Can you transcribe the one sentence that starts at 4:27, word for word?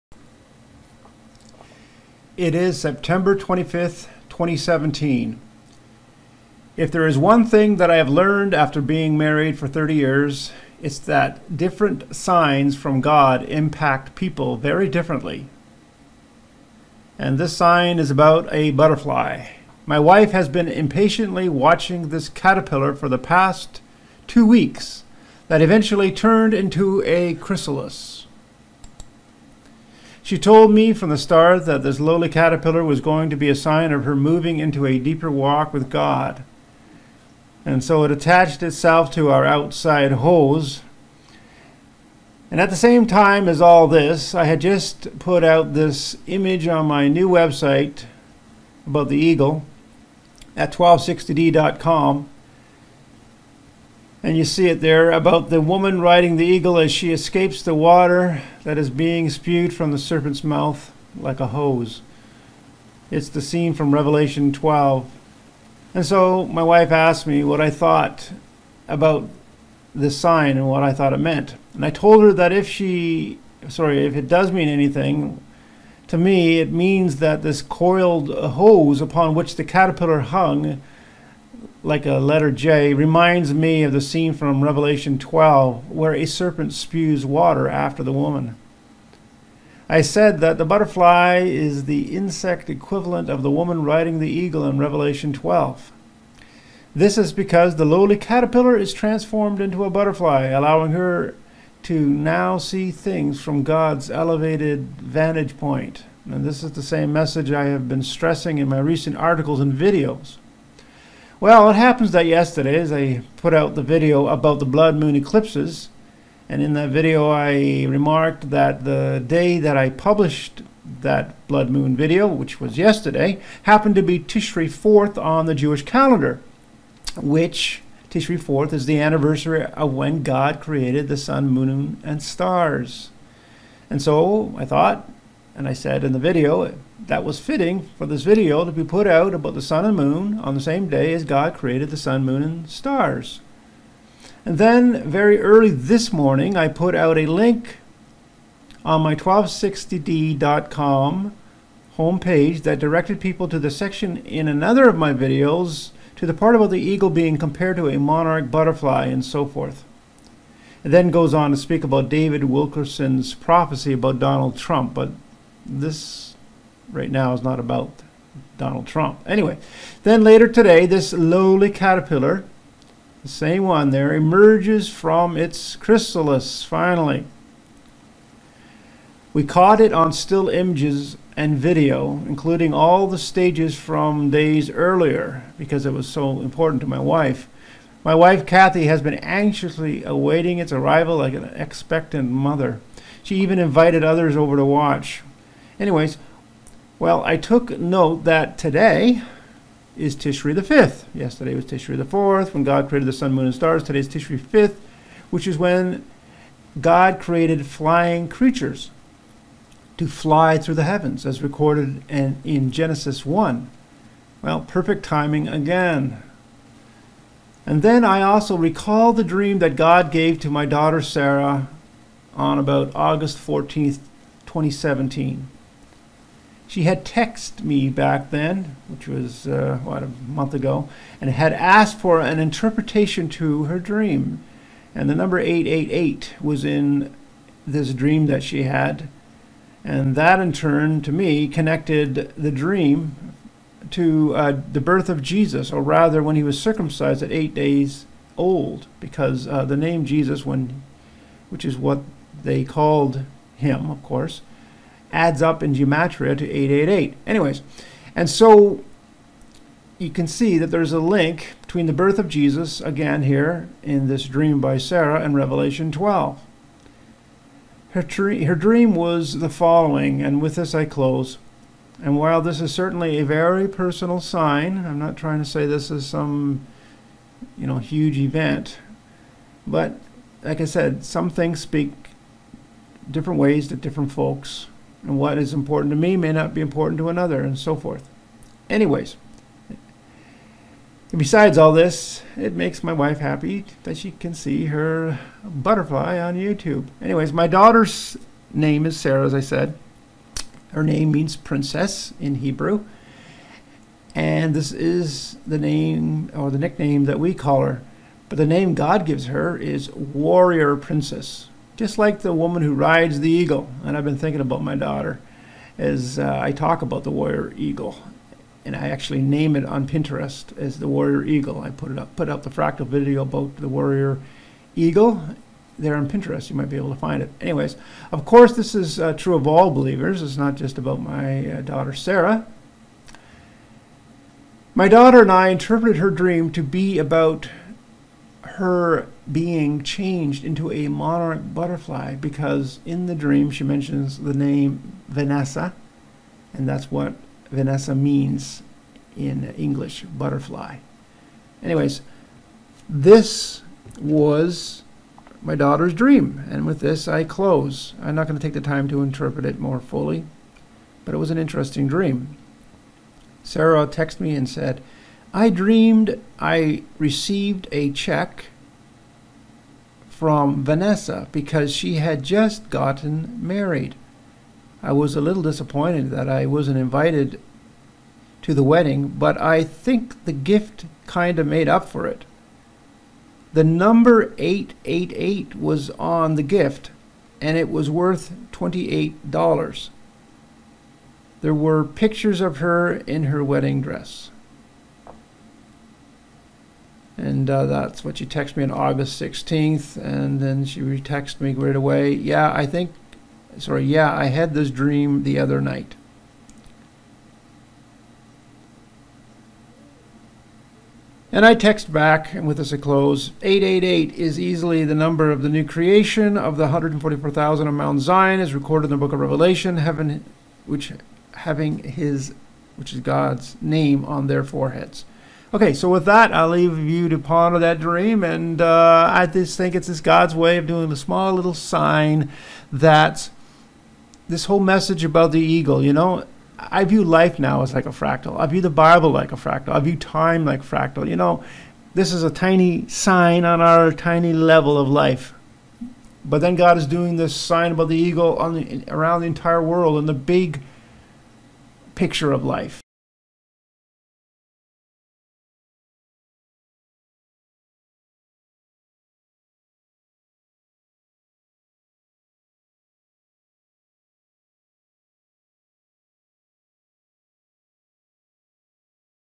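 Her, her dream was the following, and with this I close.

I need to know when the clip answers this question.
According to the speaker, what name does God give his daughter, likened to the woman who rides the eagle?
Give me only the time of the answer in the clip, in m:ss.
5:09.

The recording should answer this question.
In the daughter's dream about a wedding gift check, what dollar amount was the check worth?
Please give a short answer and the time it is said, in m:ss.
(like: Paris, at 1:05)
$28, at 6:28.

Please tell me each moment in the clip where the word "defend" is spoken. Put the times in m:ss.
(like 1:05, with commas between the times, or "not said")
not said.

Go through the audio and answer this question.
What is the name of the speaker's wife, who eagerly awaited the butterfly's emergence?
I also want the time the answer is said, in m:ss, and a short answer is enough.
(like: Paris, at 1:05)
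Kathy, at 3:08.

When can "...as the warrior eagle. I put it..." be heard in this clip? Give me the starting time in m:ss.
5:20.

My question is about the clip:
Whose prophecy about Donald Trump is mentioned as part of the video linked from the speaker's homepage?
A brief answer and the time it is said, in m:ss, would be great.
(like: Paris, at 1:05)
David Wilkerson, at 2:42.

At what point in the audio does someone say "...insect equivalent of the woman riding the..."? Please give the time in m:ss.
1:32.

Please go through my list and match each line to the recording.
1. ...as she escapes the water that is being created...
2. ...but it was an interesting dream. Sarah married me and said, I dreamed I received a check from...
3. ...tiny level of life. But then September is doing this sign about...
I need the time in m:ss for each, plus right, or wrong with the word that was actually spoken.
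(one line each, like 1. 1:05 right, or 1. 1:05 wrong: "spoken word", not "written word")
1. 0:56 wrong: "spewed", not "created"
2. 6:01 wrong: "texted", not "married"
3. 7:23 wrong: "God", not "September".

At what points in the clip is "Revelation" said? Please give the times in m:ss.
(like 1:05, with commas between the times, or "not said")
1:03, 1:24, 1:34, 4:25, 6:59.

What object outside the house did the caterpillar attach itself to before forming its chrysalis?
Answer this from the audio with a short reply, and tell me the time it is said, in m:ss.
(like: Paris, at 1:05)
outside hose, at 0:39.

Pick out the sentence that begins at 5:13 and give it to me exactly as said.
And I've been thinking about my daughter as uh, I talk about the warrior eagle.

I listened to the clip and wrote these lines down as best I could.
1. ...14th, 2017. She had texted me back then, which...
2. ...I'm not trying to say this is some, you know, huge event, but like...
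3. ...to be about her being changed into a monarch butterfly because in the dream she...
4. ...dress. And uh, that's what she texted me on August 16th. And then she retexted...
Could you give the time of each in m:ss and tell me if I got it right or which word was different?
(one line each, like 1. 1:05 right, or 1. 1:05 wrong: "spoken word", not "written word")
1. 3:43 right
2. 4:34 right
3. 5:36 right
4. 6:33 right.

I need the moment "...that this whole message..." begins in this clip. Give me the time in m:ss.
7:12.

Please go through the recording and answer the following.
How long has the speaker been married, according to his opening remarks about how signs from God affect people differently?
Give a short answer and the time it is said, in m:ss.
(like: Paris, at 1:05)
30 years, at 0:09.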